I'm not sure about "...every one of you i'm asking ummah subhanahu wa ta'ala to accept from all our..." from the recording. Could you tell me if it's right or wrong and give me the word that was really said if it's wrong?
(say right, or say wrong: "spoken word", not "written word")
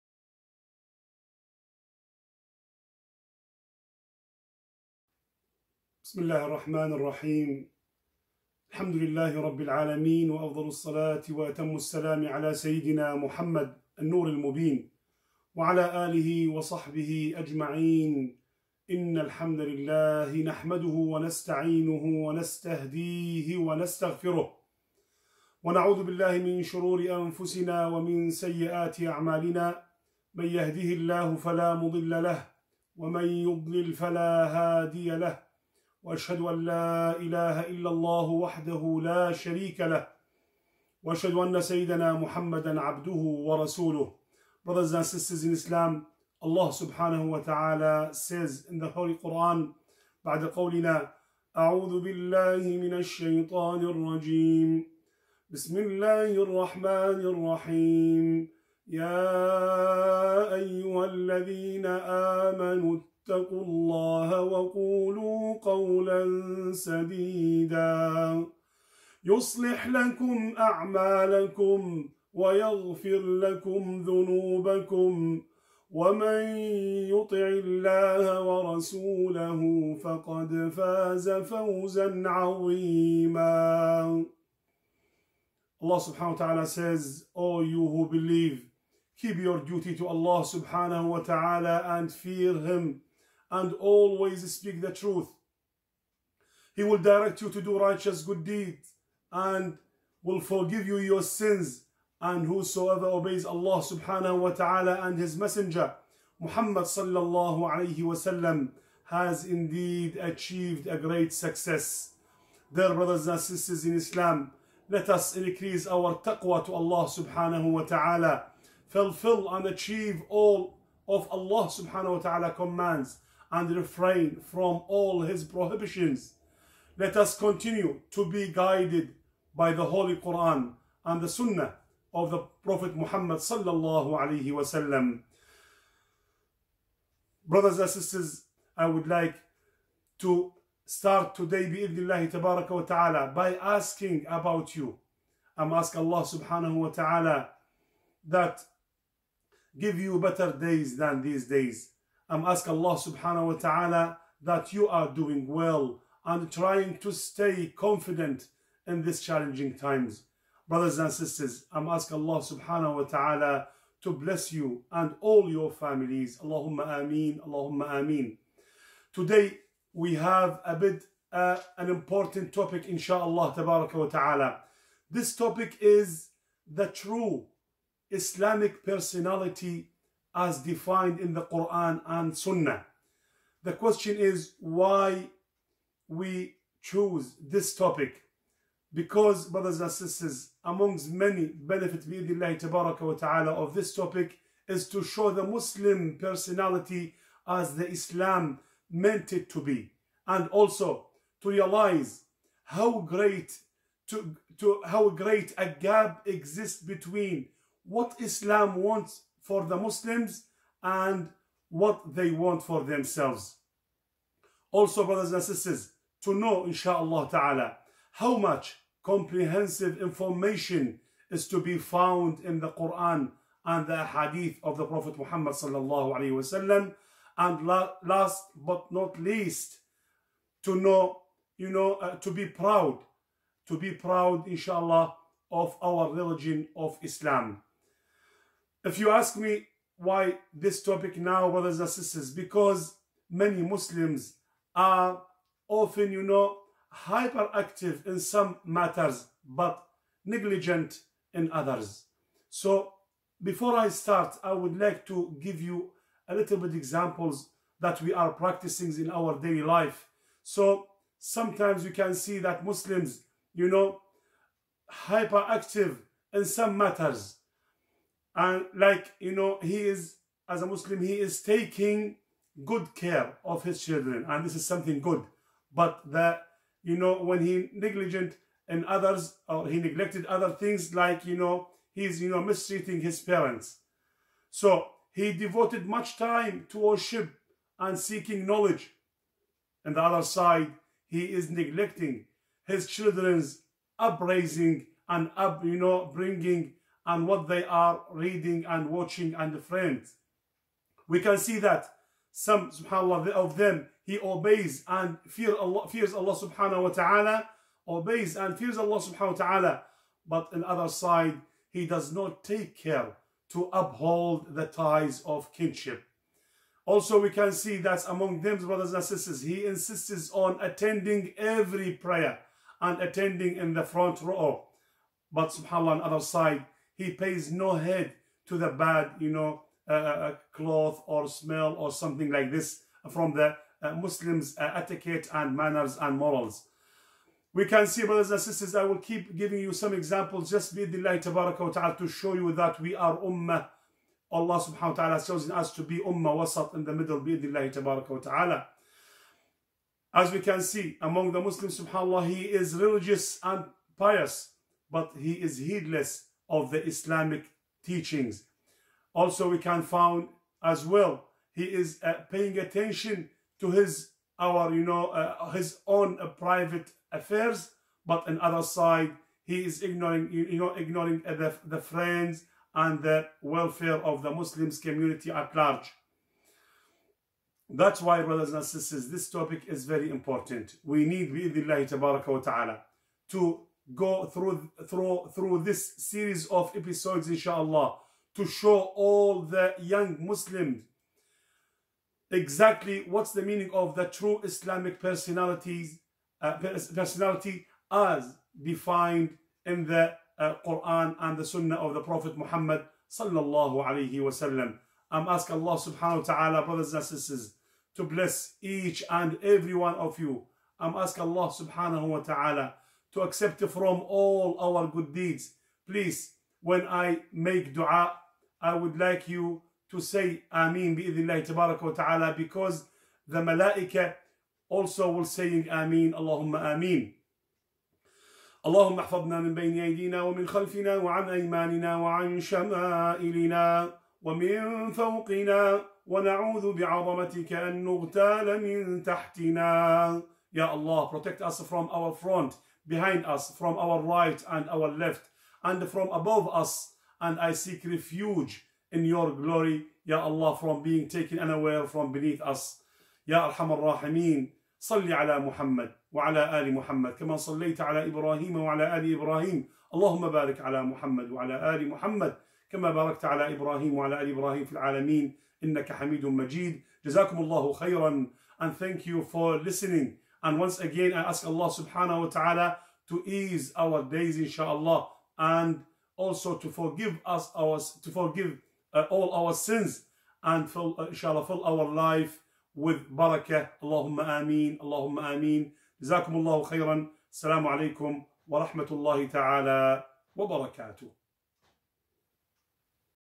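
wrong: "allah", not "ummah".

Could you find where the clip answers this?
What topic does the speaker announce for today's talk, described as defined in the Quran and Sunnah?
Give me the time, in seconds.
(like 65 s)
176 s.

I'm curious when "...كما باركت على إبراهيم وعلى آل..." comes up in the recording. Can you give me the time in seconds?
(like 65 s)
462 s.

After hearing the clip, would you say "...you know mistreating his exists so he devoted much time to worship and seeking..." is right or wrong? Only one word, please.
wrong.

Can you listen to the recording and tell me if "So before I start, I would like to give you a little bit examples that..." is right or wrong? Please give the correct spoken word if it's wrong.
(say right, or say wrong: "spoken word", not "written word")
right.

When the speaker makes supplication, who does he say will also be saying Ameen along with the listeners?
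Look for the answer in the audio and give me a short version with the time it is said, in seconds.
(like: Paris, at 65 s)
The malaika, at 423 s.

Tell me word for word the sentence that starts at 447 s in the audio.
And I seek refuge in your glory, Ya Allah, from being taken unaware from beneath us.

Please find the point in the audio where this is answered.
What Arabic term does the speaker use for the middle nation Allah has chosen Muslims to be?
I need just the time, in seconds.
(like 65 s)
345 s.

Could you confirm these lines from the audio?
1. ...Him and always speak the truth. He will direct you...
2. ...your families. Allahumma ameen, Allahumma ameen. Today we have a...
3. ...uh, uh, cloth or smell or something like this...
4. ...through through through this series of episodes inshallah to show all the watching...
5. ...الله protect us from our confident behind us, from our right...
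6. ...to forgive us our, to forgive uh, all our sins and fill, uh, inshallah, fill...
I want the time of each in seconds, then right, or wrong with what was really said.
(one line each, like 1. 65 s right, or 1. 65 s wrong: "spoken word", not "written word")
1. 92 s right
2. 165 s right
3. 329 s right
4. 384 s wrong: "young", not "watching"
5. 440 s wrong: "front", not "confident"
6. 476 s right.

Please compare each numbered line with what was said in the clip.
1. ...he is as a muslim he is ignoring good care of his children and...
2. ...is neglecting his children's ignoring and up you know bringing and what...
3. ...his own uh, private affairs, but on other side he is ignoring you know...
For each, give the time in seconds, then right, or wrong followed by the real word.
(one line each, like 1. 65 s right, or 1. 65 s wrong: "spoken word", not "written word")
1. 269 s wrong: "taking", not "ignoring"
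2. 291 s wrong: "upbringing", not "ignoring"
3. 365 s right.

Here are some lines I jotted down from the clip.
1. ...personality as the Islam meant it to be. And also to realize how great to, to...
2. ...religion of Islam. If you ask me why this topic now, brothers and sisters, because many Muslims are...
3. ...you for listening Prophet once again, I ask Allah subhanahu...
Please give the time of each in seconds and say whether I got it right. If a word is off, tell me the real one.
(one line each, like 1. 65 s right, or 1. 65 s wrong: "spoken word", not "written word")
1. 196 s right
2. 236 s right
3. 469 s wrong: "And", not "Prophet".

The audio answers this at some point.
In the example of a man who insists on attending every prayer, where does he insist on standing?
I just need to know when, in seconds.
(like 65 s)
323 s.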